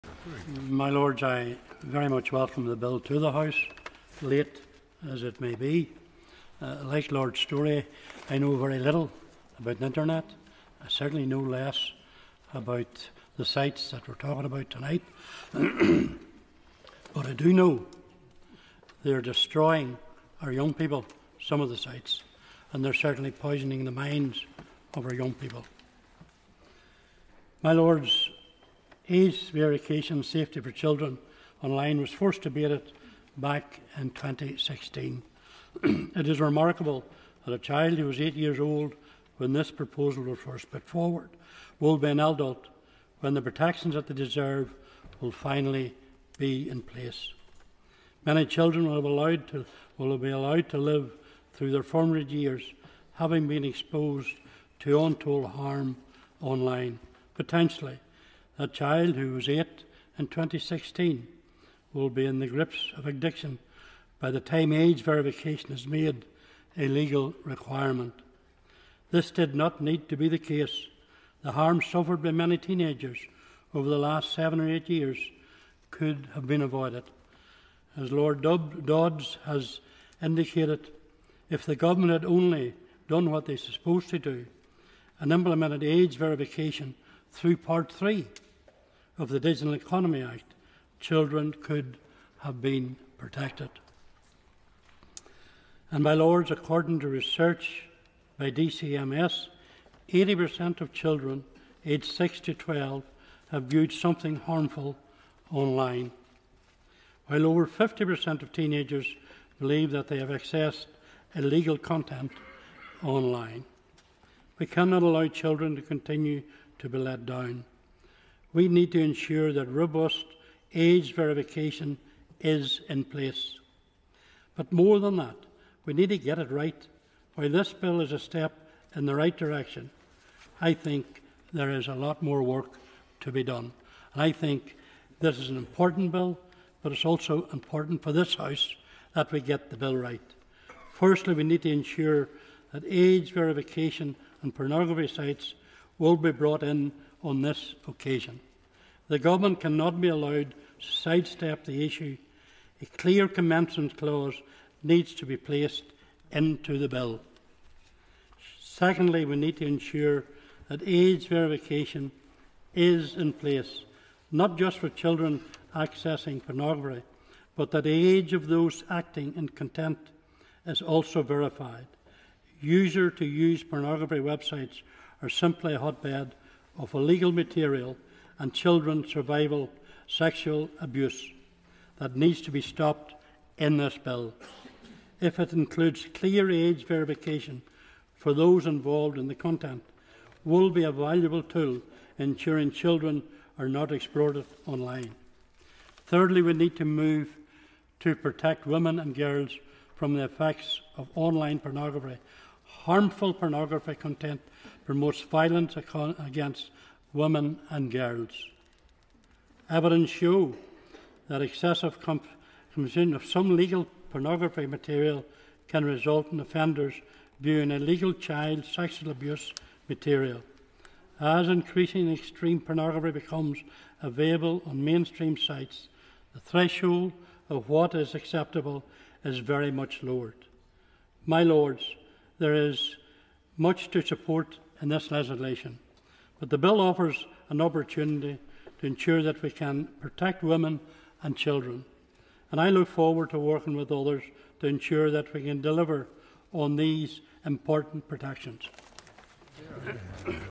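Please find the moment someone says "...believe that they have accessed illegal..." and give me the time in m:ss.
1:49.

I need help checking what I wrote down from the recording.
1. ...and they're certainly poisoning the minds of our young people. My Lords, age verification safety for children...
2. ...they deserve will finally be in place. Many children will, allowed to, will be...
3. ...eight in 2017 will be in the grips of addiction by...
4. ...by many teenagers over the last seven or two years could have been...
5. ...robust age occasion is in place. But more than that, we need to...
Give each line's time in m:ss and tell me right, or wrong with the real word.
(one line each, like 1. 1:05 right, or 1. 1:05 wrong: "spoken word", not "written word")
1. 0:22 right
2. 0:44 right
3. 0:59 wrong: "2016", not "2017"
4. 1:12 wrong: "eight", not "two"
5. 1:59 wrong: "verification", not "occasion".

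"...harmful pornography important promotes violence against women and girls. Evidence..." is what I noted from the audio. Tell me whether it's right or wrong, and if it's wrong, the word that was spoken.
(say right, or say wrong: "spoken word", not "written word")
wrong: "content", not "important".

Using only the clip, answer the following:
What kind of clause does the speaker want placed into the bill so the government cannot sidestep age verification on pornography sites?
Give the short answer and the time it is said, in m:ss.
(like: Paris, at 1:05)
commencement clause, at 2:33.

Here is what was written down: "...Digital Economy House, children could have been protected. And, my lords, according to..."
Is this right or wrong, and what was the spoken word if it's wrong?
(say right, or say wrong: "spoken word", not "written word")
wrong: "Act", not "House".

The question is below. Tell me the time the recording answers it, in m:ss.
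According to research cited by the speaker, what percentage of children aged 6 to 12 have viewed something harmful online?
1:40.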